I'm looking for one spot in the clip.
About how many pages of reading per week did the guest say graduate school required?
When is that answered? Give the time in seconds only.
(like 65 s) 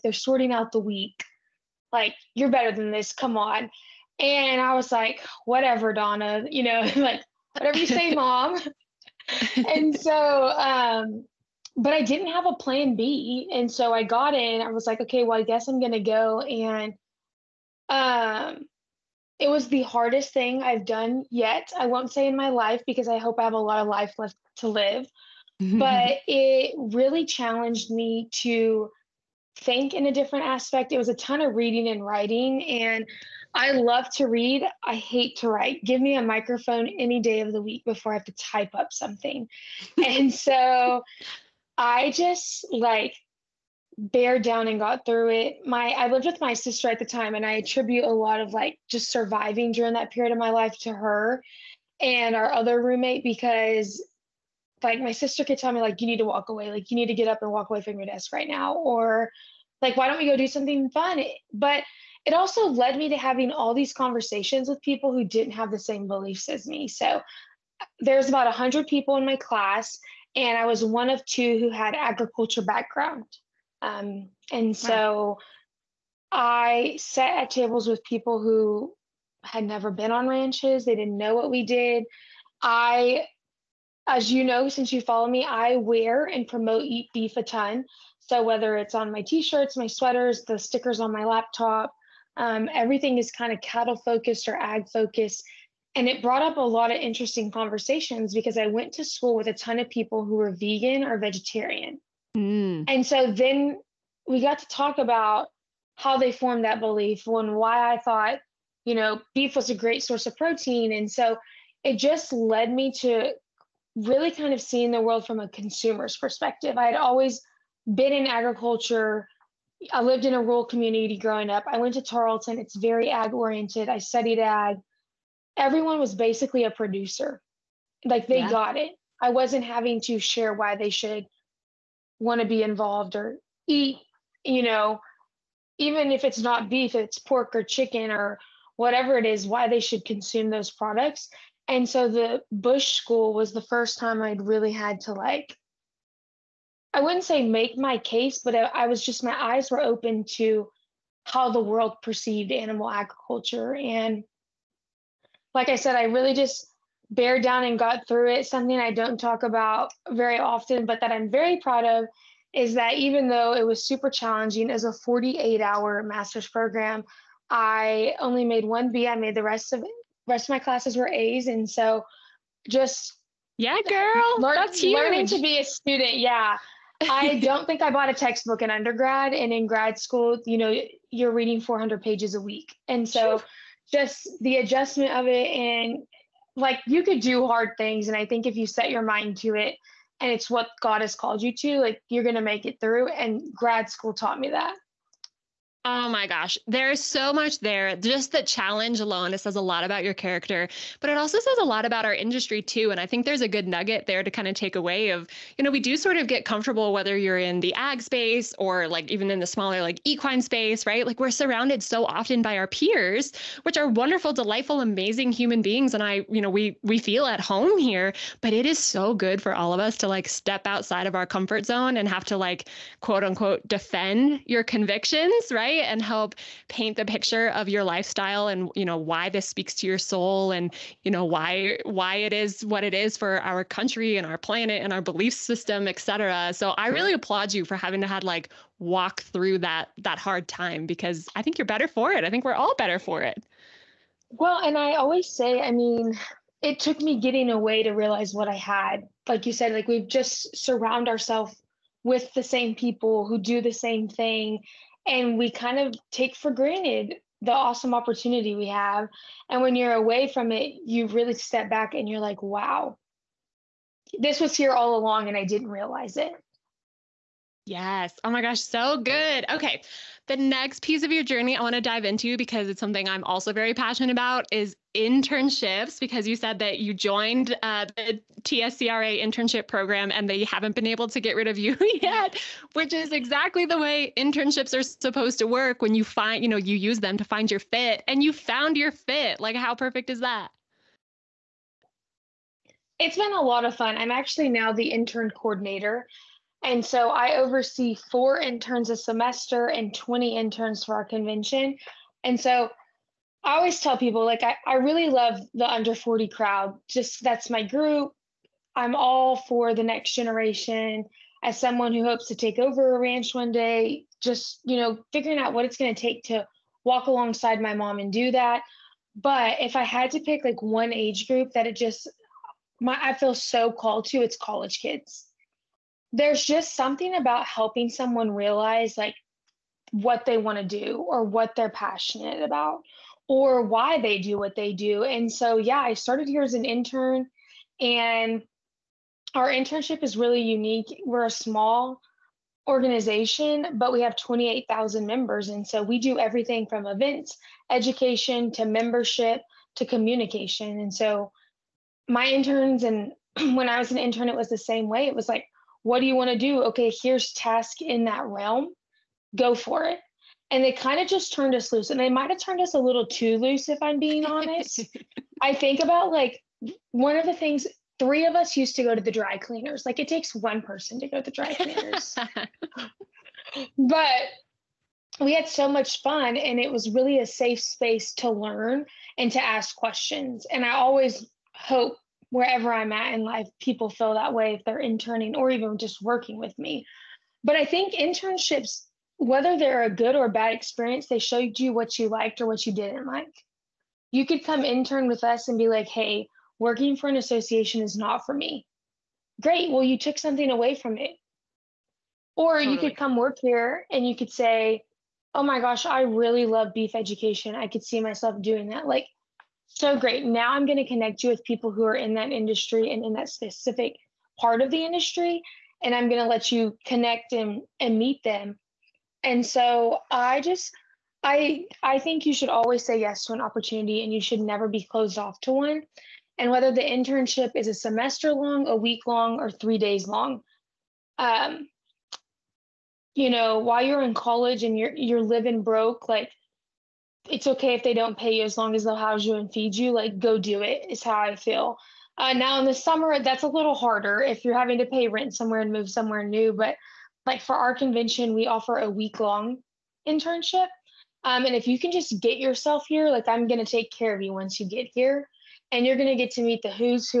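181 s.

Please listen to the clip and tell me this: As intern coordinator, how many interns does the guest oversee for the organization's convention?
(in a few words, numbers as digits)
20.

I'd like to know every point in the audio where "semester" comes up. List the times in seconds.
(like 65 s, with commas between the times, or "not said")
298 s, 427 s.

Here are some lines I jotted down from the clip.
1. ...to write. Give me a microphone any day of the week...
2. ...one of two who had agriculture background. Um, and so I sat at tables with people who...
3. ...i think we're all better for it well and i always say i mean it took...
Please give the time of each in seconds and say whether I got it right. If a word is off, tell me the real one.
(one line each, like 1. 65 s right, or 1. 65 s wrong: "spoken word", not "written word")
1. 35 s right
2. 70 s right
3. 242 s right.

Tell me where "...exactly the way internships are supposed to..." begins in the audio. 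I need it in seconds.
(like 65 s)
283 s.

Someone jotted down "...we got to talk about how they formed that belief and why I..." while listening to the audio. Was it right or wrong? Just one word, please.
right.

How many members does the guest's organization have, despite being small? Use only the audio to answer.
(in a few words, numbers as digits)
28,000.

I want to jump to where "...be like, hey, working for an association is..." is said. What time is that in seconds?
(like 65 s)
395 s.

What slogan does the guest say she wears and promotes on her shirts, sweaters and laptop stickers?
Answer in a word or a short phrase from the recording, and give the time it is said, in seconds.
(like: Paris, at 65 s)
Eat Beef, at 86 s.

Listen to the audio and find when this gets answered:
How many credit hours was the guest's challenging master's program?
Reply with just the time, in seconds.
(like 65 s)
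164 s.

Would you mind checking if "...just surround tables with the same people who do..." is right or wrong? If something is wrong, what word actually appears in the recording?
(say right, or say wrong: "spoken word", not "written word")
wrong: "ourselves", not "tables".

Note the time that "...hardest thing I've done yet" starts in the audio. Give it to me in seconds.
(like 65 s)
19 s.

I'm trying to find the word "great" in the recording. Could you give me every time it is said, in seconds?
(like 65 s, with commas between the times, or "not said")
109 s, 399 s, 409 s.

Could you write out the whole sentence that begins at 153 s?
And like I said, I really just, bear down and got through it.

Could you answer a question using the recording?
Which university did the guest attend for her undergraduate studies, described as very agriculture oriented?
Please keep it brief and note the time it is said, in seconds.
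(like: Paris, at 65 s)
Tarleton, at 122 s.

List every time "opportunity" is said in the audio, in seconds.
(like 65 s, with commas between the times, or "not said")
257 s, 423 s.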